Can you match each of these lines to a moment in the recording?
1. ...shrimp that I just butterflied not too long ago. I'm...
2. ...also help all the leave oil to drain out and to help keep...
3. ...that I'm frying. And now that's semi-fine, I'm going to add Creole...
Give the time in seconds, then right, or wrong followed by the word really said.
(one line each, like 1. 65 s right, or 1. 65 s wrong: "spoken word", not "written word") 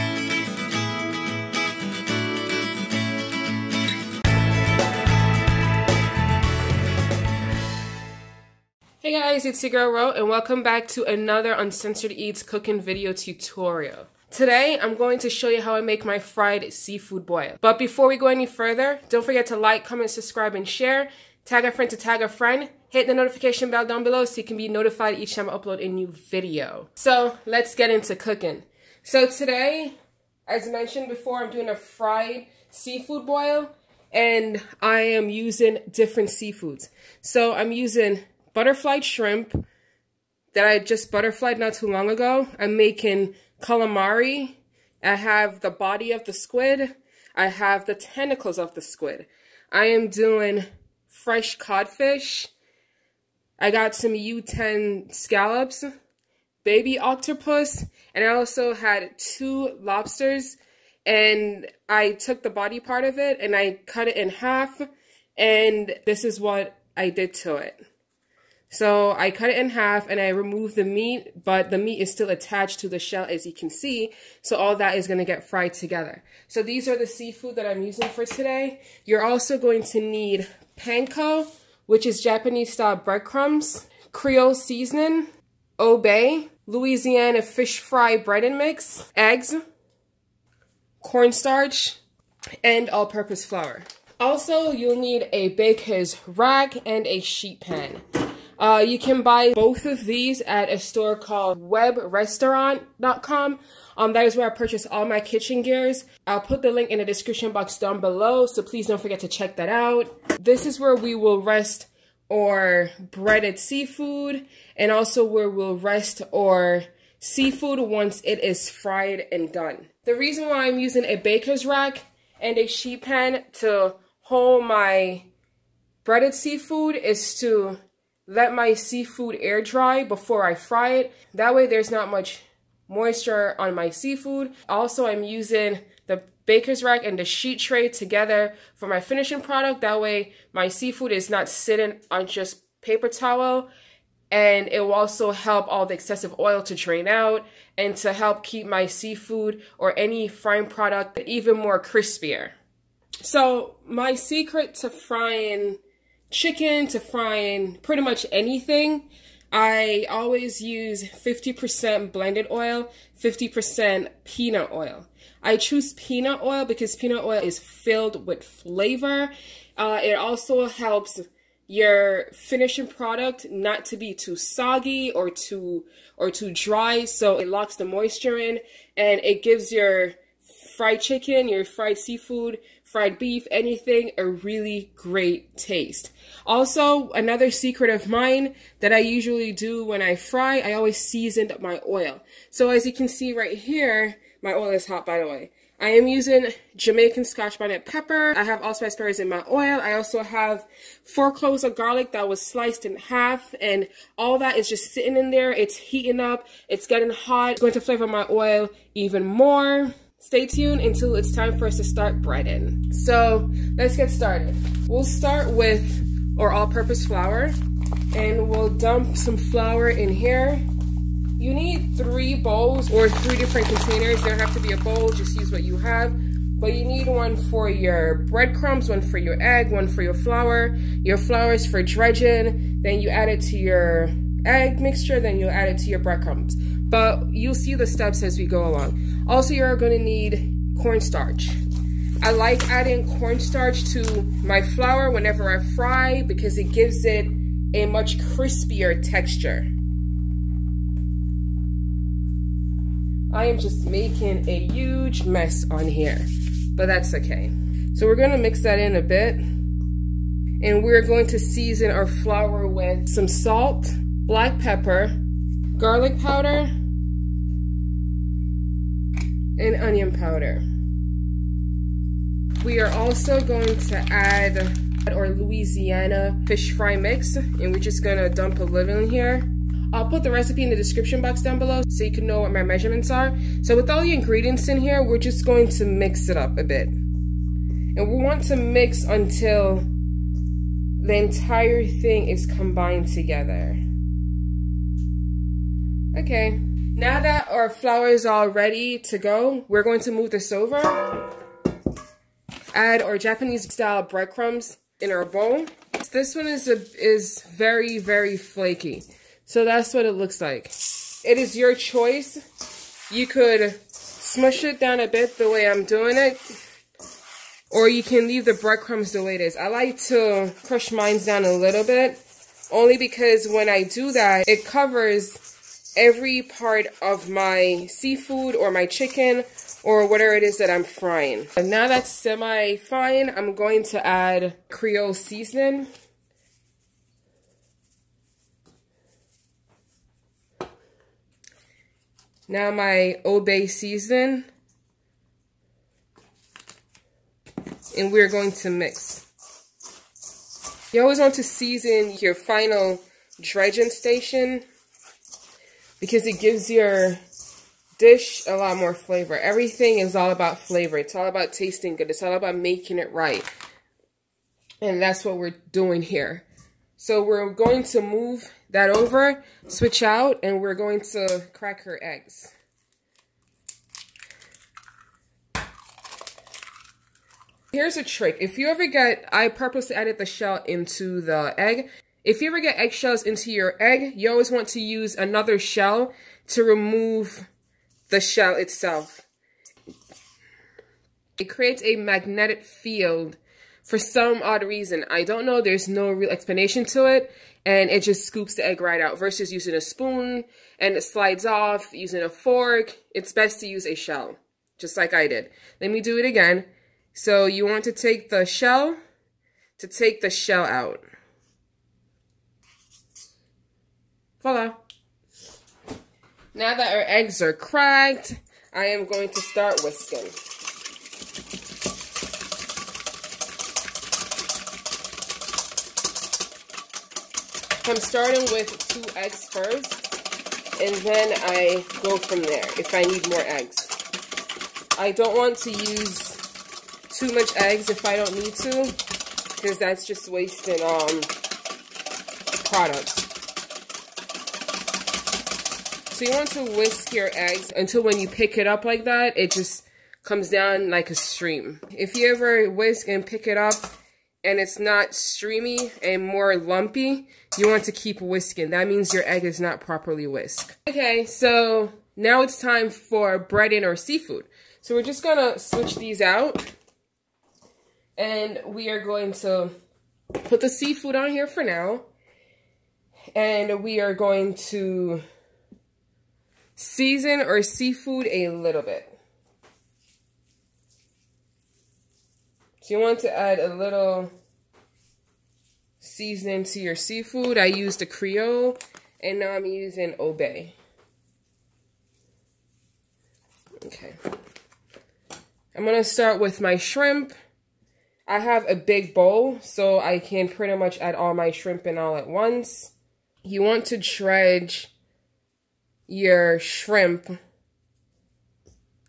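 1. 39 s right
2. 144 s wrong: "excessive", not "leave"
3. 330 s right.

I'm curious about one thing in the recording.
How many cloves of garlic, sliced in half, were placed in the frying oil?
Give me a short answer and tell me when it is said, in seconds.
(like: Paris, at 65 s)
4, at 201 s.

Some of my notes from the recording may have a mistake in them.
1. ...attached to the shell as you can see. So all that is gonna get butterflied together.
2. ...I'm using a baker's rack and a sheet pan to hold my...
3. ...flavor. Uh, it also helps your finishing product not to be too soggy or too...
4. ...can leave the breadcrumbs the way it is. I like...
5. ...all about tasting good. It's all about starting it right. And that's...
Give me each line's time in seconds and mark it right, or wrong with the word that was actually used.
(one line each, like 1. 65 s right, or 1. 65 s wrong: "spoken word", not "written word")
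1. 72 s wrong: "fried", not "butterflied"
2. 120 s right
3. 168 s right
4. 318 s right
5. 361 s wrong: "making", not "starting".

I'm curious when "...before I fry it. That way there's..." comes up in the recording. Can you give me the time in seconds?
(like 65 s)
130 s.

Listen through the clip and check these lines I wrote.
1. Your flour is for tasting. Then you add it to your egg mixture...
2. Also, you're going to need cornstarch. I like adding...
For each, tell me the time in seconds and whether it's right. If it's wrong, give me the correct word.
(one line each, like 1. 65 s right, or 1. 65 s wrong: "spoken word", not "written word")
1. 231 s wrong: "dredging", not "tasting"
2. 239 s right.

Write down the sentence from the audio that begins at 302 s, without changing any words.
Add our Japanese style breadcrumbs in our bowl.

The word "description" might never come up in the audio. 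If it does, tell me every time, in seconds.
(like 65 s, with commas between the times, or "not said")
107 s, 280 s.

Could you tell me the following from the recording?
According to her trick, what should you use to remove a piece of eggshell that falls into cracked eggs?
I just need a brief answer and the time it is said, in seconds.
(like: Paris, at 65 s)
Another shell, at 385 s.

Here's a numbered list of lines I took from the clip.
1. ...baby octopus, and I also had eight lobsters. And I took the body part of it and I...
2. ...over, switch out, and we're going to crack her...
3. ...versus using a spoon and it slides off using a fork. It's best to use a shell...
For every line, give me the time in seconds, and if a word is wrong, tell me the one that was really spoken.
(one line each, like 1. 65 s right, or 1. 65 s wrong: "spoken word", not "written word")
1. 56 s wrong: "two", not "eight"
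2. 368 s right
3. 399 s right.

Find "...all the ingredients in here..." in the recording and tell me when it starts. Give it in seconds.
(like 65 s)
283 s.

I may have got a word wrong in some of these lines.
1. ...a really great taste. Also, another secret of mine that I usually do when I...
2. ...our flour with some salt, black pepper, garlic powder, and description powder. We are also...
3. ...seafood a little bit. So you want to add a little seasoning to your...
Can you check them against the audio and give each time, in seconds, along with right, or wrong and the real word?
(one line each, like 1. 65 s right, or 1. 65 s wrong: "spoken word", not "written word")
1. 184 s right
2. 261 s wrong: "onion", not "description"
3. 477 s right.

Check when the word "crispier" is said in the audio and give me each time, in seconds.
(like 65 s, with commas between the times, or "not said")
151 s, 248 s.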